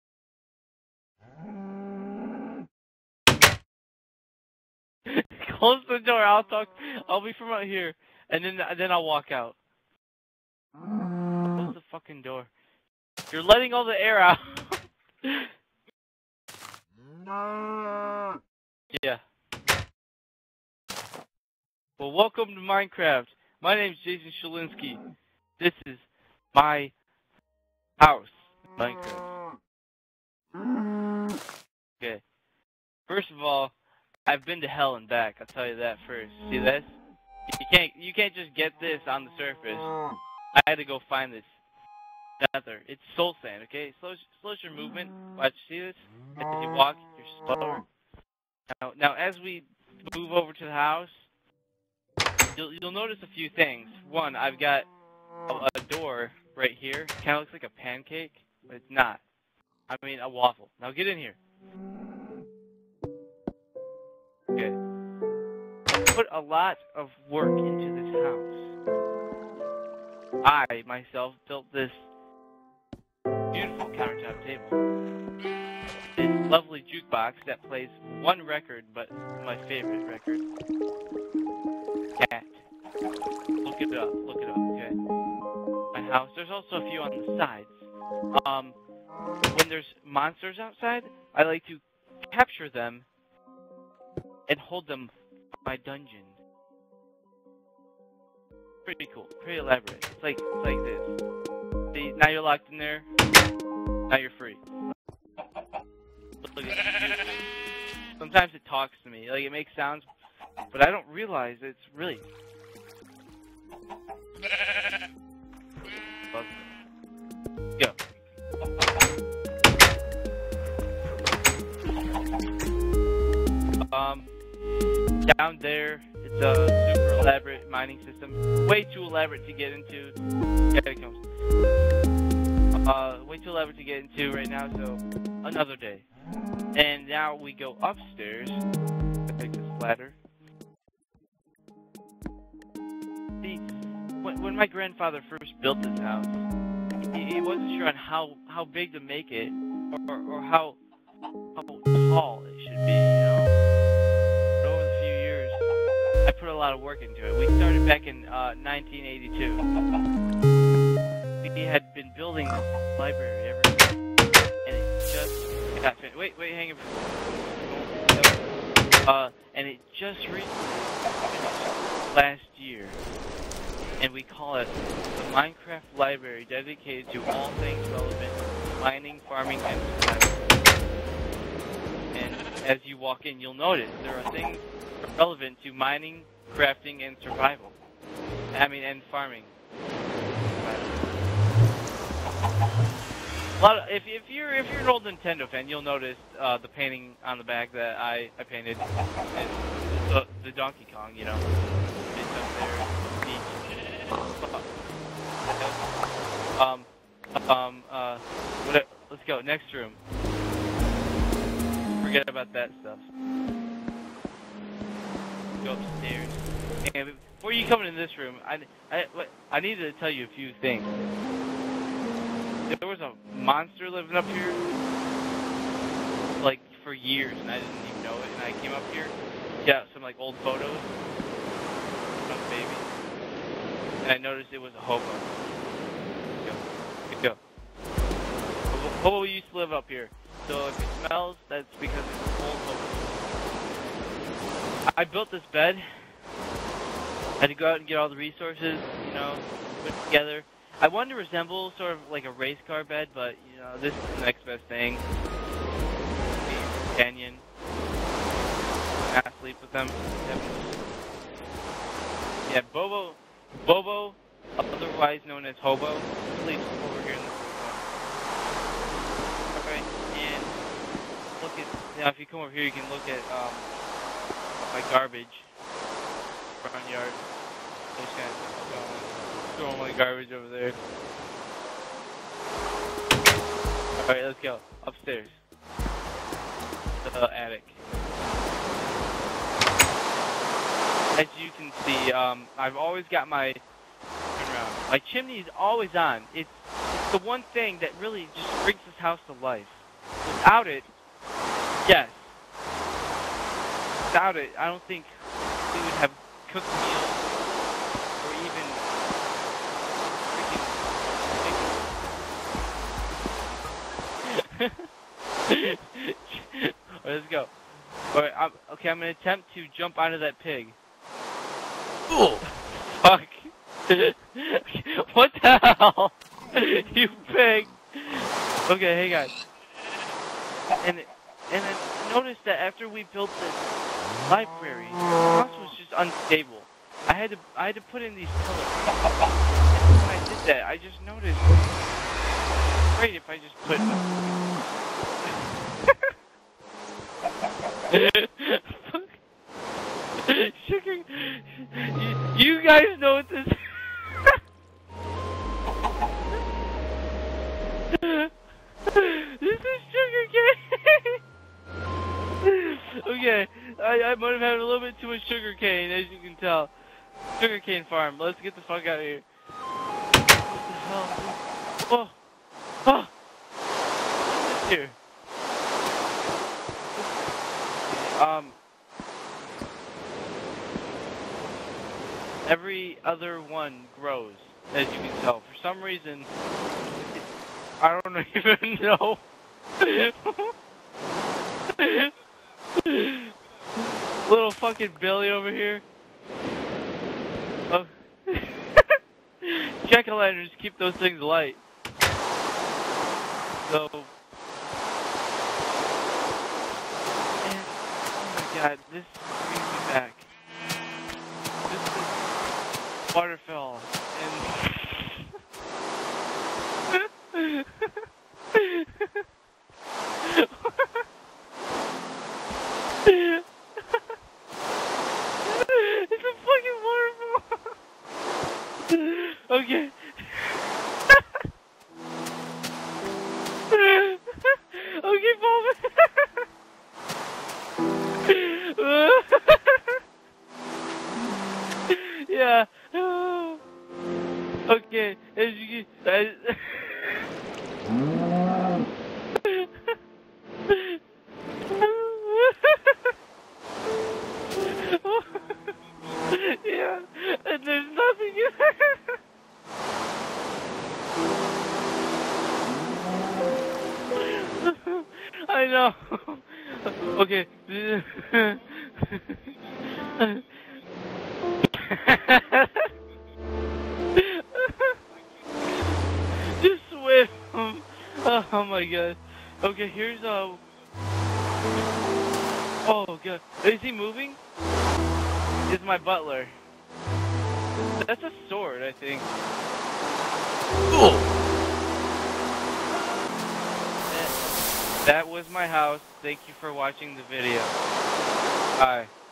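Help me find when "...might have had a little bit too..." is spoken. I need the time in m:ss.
6:04.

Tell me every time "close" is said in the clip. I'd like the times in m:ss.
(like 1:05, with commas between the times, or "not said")
0:05, 0:10.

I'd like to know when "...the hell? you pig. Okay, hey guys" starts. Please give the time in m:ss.
5:25.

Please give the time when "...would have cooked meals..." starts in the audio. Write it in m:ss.
5:05.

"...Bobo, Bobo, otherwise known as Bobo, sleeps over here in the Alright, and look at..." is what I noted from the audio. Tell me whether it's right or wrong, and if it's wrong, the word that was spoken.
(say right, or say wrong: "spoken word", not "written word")
wrong: "Hobo", not "Bobo".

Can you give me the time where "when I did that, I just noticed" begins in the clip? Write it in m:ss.
5:39.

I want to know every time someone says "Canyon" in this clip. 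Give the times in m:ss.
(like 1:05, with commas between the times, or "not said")
4:16.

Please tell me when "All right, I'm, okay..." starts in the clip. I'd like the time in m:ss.
5:18.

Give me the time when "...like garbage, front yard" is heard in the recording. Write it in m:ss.
4:34.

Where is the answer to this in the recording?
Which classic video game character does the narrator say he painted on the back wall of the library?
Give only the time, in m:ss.
3:20.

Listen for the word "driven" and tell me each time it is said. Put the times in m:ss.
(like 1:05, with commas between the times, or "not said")
not said.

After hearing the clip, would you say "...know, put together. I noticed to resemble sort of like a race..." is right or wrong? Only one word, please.
wrong.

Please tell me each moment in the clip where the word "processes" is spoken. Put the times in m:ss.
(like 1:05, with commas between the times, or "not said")
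not said.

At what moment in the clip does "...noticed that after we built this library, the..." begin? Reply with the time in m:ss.
5:32.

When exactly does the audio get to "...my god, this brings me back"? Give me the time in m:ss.
6:48.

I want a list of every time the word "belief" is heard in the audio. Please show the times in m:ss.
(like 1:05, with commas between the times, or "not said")
not said.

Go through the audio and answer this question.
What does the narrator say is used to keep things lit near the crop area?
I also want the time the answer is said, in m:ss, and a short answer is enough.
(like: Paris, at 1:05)
Jack o' lanterns, at 6:39.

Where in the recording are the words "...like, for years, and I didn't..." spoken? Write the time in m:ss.
3:46.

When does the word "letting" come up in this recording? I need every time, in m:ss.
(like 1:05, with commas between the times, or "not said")
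0:13.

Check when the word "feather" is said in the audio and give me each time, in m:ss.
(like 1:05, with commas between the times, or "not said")
0:42.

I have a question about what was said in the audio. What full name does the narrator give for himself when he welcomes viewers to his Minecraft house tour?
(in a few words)
Jason Shalinsky.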